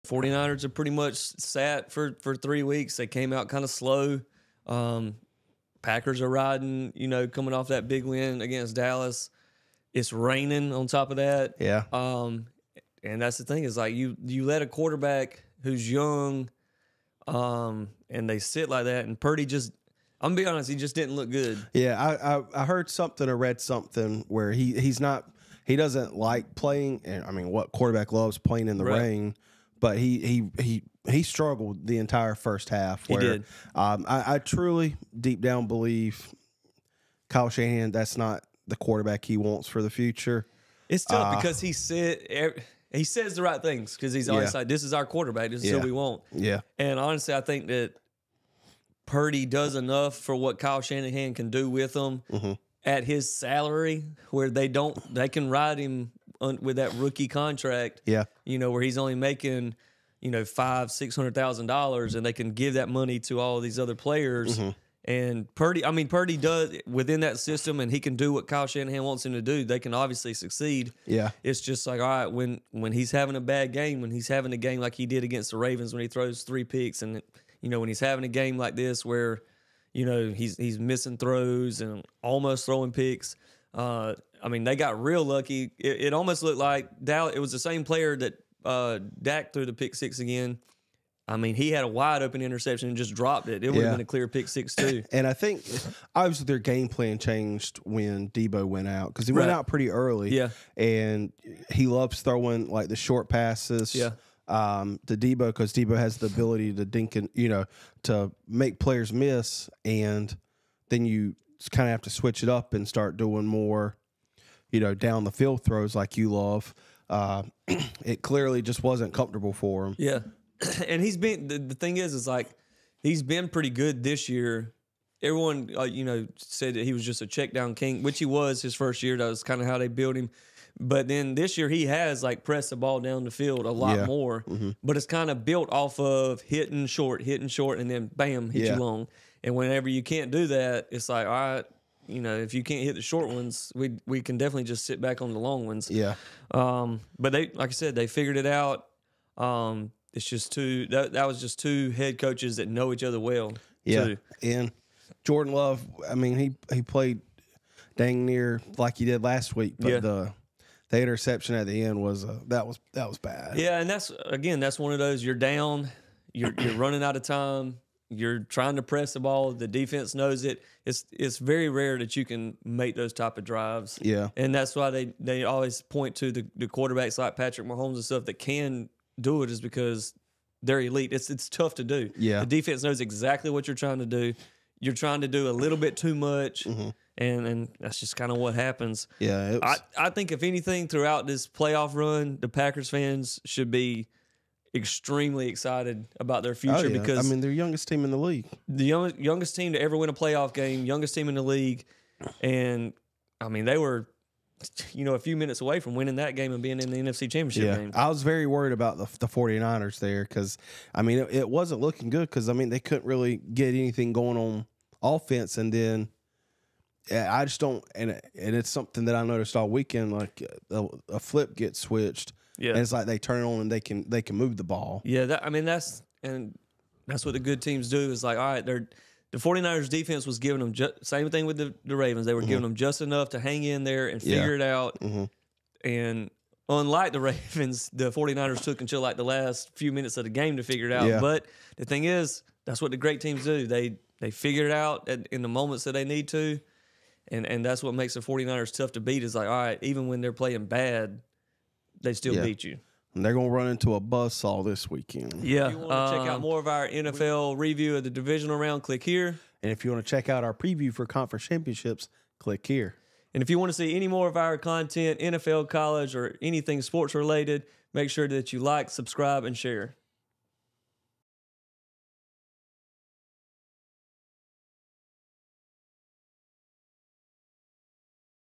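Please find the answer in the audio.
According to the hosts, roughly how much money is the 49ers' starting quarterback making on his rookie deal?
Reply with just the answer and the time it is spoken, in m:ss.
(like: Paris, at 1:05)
500-600 thousand dollars, at 1:00.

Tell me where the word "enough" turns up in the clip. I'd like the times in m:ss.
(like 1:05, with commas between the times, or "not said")
0:49, 3:53.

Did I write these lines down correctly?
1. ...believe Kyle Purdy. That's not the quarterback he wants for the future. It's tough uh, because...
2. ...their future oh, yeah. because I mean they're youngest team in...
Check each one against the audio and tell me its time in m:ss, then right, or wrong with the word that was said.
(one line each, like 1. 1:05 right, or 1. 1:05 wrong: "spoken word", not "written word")
1. 0:35 wrong: "Shanahan", not "Purdy"
2. 3:16 right.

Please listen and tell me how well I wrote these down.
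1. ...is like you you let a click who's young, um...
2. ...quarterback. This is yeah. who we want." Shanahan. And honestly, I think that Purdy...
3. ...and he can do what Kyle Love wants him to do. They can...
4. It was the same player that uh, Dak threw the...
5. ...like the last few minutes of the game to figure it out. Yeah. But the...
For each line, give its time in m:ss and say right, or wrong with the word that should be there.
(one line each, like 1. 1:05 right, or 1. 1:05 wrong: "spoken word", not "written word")
1. 0:13 wrong: "quarterback", not "click"
2. 0:45 wrong: "Yeah", not "Shanahan"
3. 1:07 wrong: "Shanahan", not "Love"
4. 1:27 right
5. 3:59 right.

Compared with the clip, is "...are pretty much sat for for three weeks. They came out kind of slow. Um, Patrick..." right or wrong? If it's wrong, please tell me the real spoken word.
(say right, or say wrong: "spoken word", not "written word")
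wrong: "Packers", not "Patrick".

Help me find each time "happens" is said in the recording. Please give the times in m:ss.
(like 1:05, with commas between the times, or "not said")
3:08.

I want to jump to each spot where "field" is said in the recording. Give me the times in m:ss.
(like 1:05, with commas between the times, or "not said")
1:55, 2:13.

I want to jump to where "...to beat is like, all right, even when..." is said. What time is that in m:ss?
4:08.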